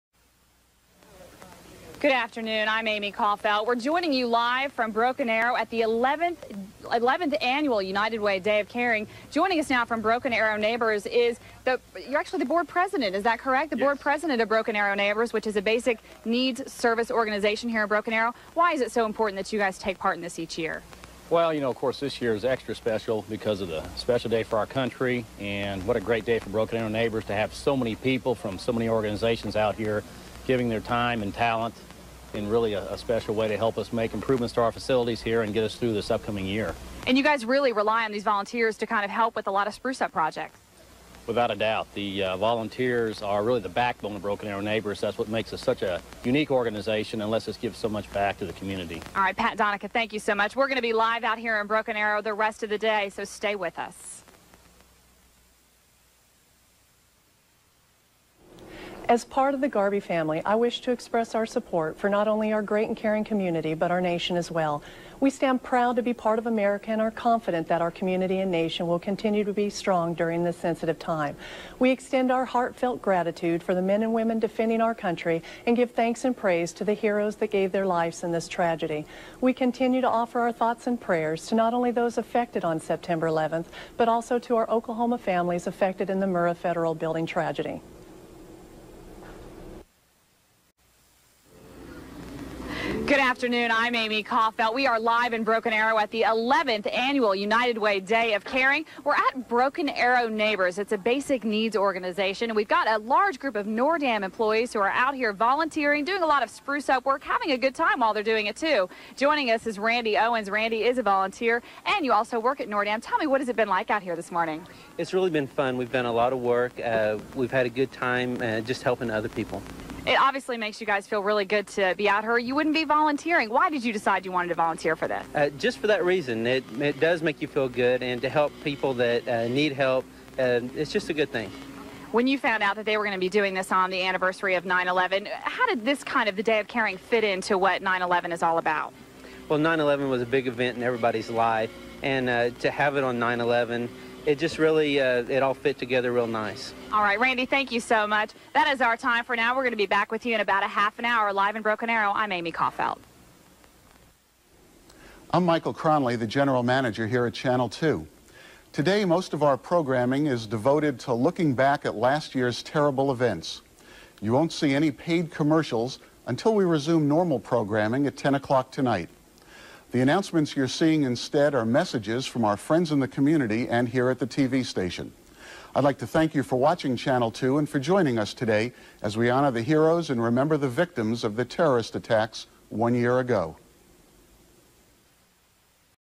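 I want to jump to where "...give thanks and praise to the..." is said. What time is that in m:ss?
1:15.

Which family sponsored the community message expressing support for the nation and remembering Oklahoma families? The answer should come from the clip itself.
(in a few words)
Garbe.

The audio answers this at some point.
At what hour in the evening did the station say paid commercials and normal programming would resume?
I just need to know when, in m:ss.
2:48.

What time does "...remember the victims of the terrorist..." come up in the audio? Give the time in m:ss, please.
3:00.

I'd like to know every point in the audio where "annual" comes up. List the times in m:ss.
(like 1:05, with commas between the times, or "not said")
0:07, 1:36.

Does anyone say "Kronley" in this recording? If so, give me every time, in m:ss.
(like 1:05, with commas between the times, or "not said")
2:35.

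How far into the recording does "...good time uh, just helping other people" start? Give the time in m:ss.
1:57.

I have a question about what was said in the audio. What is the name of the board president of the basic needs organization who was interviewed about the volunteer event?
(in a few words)
Pat Donica.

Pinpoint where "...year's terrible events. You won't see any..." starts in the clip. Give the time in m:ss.
2:42.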